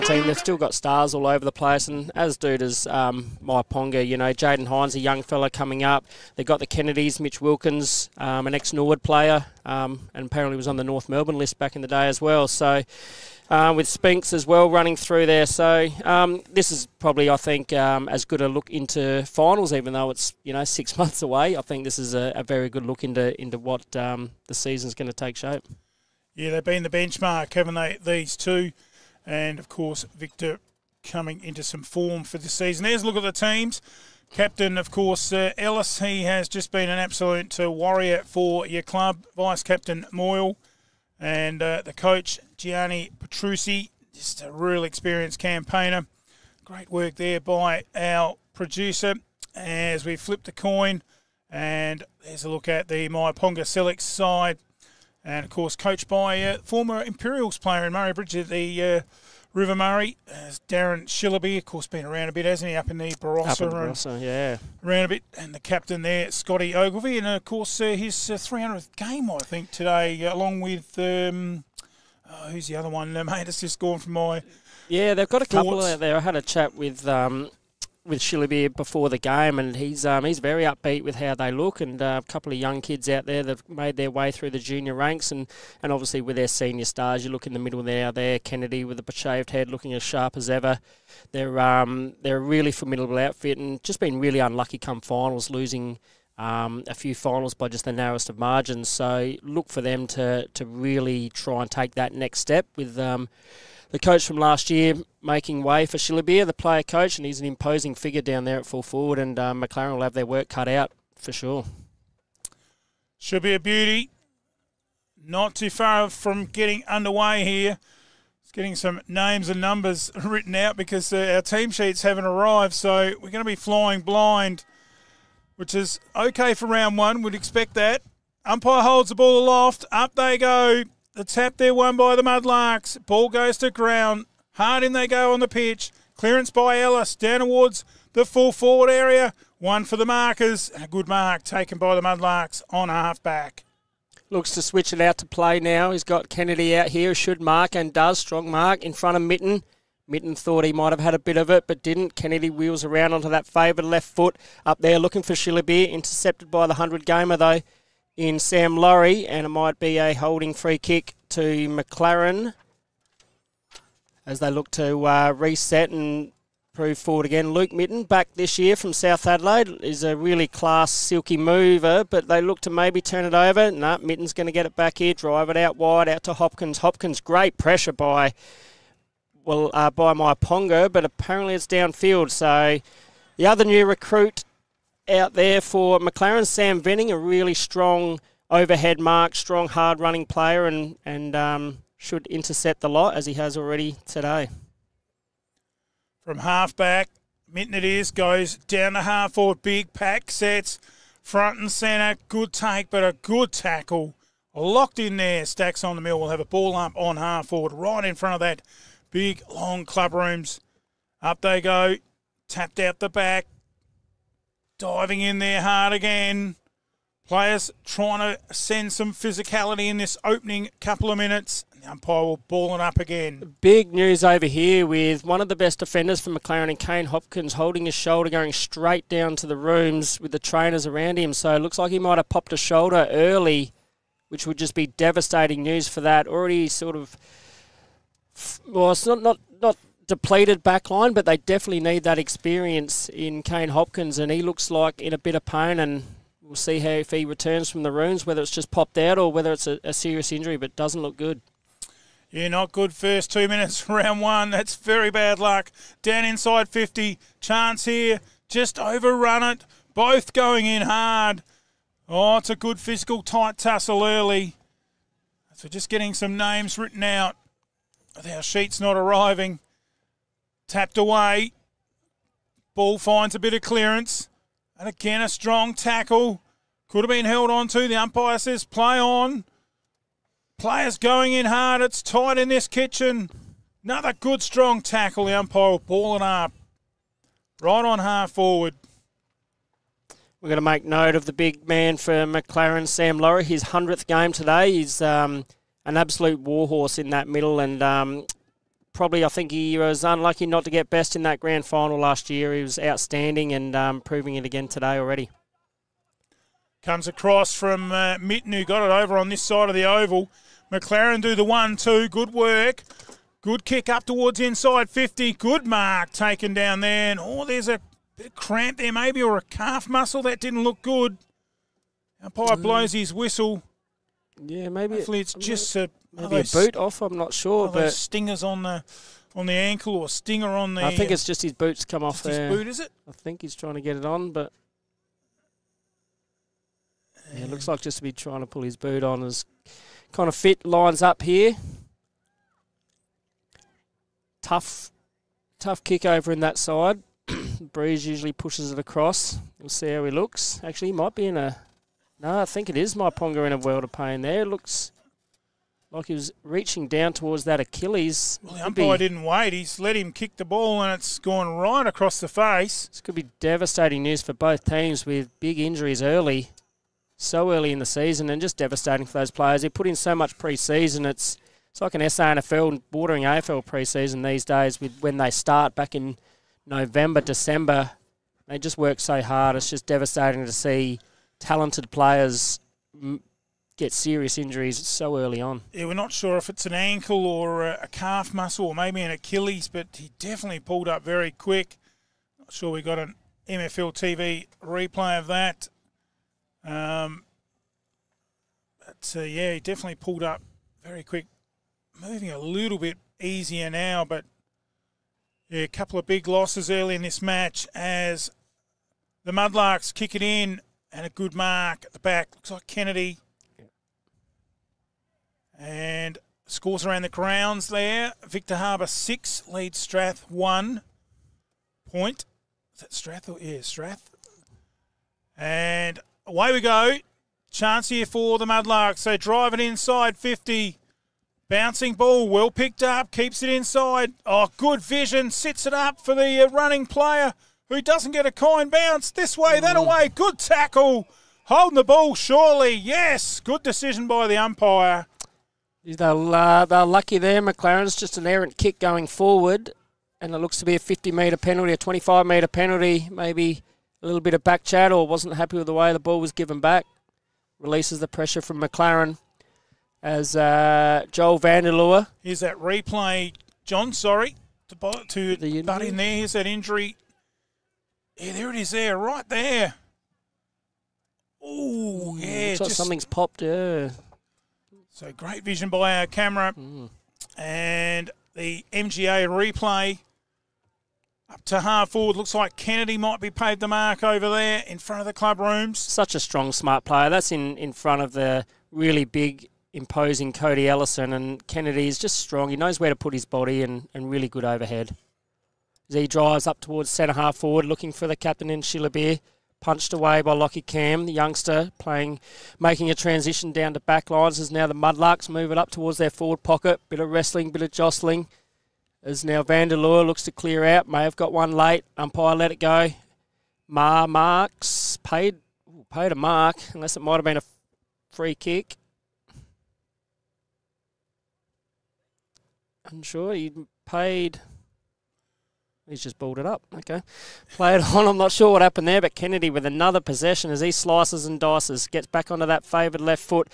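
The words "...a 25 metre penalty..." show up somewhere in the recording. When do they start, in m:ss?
7:31.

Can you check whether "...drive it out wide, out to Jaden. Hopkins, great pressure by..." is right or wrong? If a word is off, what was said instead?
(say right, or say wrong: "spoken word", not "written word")
wrong: "Hopkins", not "Jaden".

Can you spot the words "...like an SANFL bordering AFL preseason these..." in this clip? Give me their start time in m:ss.
6:11.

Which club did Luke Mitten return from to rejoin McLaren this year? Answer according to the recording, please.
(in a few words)
South Adelaide.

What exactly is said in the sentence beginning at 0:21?
I think this is a, a very good look into into what um, the season's going to take shape.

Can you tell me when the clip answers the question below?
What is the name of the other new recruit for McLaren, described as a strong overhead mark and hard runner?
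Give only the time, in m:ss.
3:06.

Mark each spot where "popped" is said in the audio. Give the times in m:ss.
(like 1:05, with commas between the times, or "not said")
3:52, 4:08, 7:53.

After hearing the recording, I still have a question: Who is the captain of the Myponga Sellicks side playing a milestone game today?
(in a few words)
Scotty Ogilvie.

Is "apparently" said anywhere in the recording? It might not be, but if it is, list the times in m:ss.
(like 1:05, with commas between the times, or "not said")
0:10, 3:01.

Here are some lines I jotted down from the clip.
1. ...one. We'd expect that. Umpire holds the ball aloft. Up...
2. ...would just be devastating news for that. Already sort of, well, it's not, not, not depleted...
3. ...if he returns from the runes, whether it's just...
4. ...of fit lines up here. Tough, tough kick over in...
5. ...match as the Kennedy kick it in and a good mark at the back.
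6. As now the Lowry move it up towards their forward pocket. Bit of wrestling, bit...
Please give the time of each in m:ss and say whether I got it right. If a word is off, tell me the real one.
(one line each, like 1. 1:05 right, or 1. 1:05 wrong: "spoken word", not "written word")
1. 2:06 right
2. 3:54 right
3. 4:06 right
4. 5:40 right
5. 6:47 wrong: "Mudlarks", not "Kennedy"
6. 8:24 wrong: "Mudlarks", not "Lowry".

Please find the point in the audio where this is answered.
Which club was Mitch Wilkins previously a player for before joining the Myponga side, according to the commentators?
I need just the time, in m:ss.
0:08.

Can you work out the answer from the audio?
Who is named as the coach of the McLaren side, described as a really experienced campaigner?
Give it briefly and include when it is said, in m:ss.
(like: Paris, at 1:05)
Gianni Petrucci, at 0:42.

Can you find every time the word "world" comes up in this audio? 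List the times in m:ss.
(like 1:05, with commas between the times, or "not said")
5:53.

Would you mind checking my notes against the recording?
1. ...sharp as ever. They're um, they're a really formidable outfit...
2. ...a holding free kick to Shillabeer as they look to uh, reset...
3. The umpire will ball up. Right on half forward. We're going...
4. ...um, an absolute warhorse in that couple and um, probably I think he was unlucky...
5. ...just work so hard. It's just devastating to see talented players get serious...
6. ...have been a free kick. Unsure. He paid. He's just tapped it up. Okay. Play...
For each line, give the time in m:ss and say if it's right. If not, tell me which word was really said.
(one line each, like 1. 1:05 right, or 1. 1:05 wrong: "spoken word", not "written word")
1. 1:30 right
2. 2:39 wrong: "McLaren", not "Shillabeer"
3. 4:45 right
4. 4:55 wrong: "middle", not "couple"
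5. 6:18 right
6. 8:37 wrong: "balled", not "tapped".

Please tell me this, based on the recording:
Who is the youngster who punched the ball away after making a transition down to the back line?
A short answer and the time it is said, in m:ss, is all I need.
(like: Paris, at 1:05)
Lockie Cam, at 8:20.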